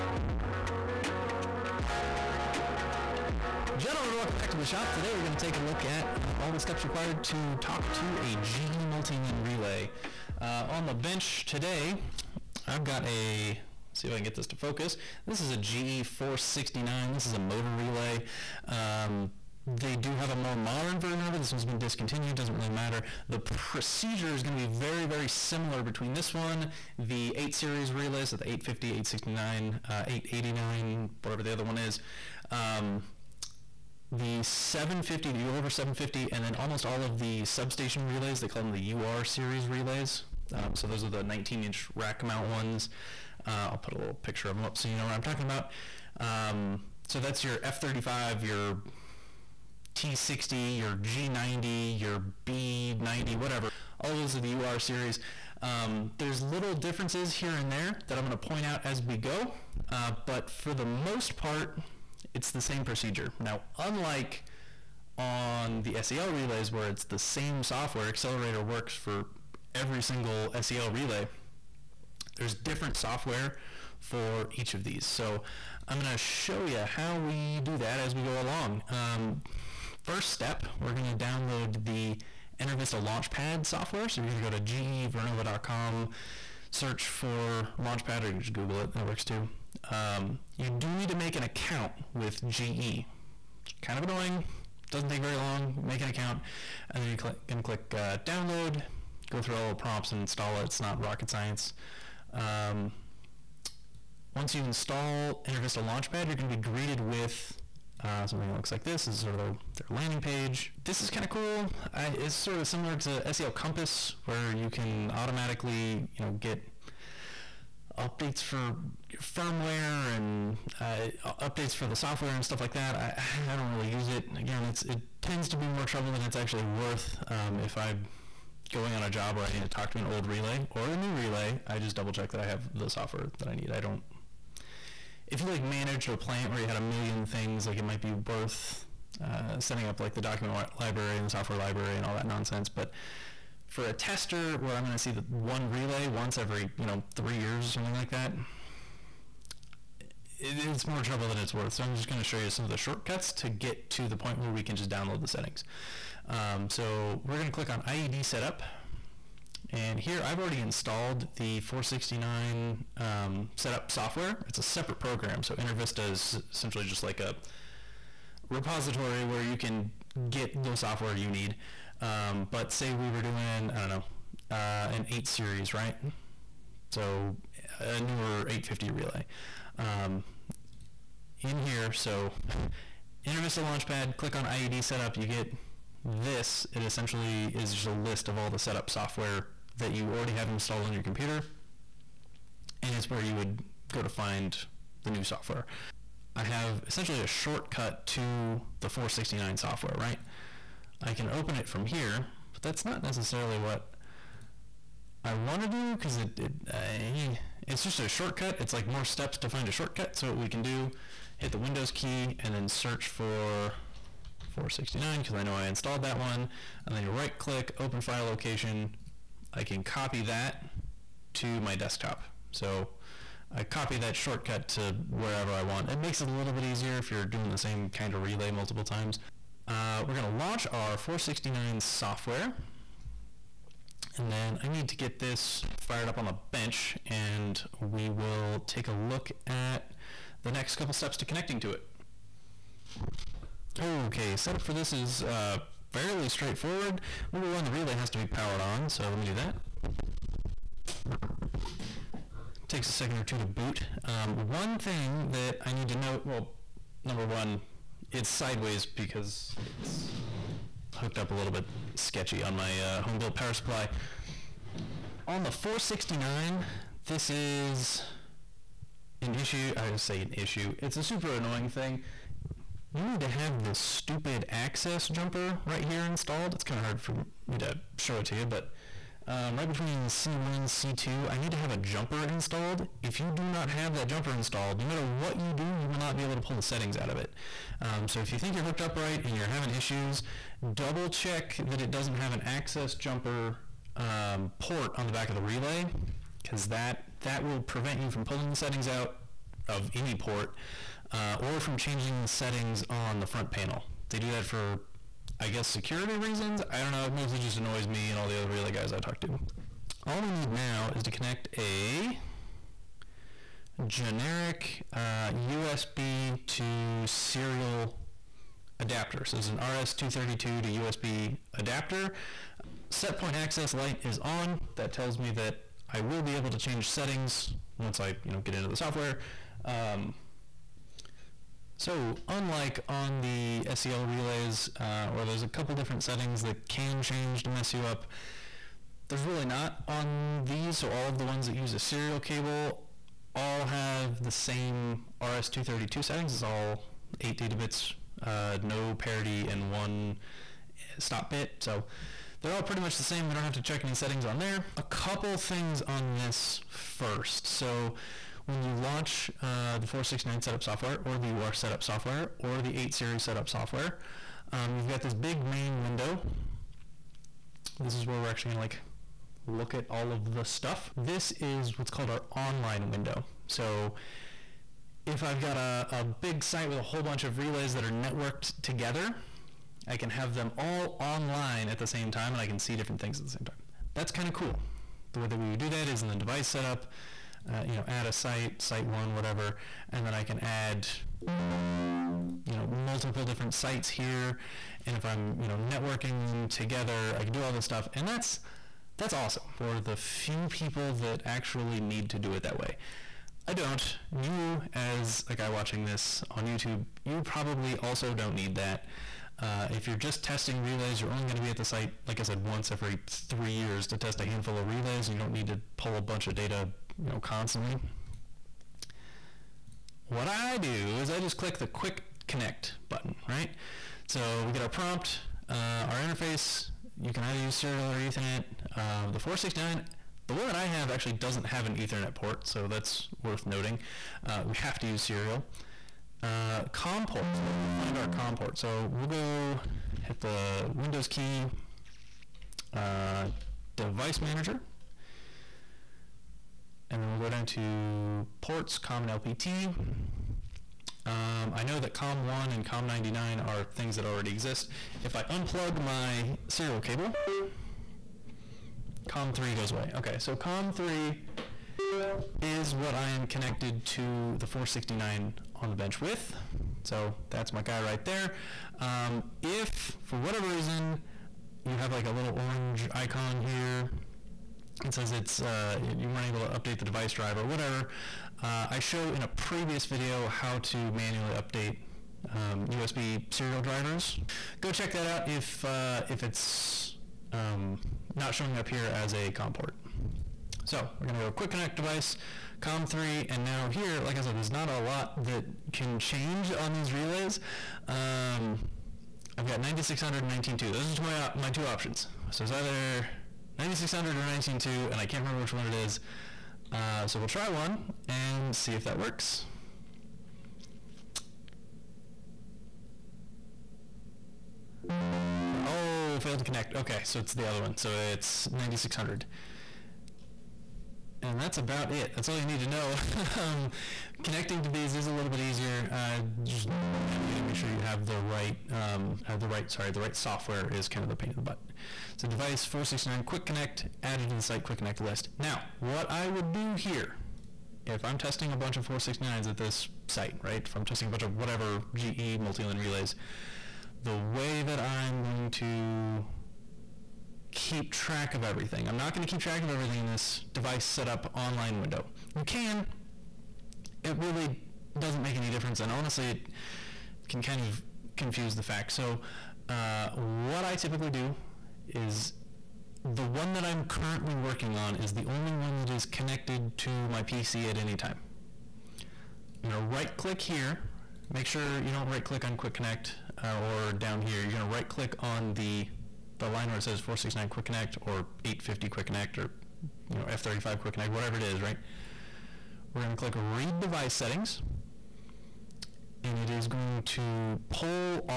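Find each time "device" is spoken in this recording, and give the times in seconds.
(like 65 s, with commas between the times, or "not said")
386 s, 443 s, 476 s, 491 s, 532 s, 550 s, 583 s.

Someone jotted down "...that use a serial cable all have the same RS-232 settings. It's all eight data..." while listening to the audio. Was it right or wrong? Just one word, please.
right.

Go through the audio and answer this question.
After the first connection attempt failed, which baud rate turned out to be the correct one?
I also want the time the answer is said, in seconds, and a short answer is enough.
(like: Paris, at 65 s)
9600, at 517 s.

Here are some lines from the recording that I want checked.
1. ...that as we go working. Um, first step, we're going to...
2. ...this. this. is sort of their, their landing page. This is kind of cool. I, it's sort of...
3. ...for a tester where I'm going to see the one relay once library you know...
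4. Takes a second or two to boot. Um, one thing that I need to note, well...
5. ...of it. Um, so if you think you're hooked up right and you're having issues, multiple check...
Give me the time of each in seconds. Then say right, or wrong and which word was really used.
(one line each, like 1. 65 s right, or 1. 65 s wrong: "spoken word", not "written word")
1. 77 s wrong: "along", not "working"
2. 108 s right
3. 143 s wrong: "every", not "library"
4. 252 s right
5. 287 s wrong: "double", not "multiple".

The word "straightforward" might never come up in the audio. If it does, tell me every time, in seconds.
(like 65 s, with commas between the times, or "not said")
246 s.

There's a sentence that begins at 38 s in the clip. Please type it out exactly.
They call them the UR series relays.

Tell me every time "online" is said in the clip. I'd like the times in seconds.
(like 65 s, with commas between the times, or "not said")
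372 s, 380 s, 551 s.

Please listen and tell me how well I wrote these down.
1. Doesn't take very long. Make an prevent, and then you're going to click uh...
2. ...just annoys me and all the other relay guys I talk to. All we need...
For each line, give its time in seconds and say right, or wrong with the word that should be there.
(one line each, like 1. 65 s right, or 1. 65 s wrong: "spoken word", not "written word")
1. 94 s wrong: "account", not "prevent"
2. 307 s right.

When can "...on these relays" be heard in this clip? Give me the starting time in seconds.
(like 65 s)
496 s.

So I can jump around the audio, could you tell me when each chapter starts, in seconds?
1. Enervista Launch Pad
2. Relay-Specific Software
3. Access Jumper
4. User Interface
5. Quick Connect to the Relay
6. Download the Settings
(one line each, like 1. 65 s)
1. 78 s
2. 172 s
3. 262 s
4. 332 s
5. 417 s
6. 535 s.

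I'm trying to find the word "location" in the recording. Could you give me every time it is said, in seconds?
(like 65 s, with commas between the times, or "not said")
218 s.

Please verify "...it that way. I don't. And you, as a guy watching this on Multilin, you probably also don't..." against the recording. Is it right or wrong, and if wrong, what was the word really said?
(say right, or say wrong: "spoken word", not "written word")
wrong: "YouTube", not "Multilin".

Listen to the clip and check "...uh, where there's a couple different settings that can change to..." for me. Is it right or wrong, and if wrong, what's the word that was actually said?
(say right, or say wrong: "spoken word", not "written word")
right.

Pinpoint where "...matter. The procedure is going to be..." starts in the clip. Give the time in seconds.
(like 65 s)
22 s.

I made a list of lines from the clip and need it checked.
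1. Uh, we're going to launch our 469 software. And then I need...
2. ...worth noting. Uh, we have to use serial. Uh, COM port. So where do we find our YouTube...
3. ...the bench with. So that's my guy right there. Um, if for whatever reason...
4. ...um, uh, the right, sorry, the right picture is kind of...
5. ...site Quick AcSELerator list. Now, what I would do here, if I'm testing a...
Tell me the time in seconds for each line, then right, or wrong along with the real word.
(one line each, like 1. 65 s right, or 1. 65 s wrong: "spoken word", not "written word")
1. 229 s right
2. 433 s wrong: "COM", not "YouTube"
3. 465 s right
4. 528 s wrong: "software", not "picture"
5. 534 s wrong: "Connect", not "AcSELerator".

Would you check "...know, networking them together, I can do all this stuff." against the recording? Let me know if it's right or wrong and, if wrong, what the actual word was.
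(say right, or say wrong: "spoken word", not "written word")
right.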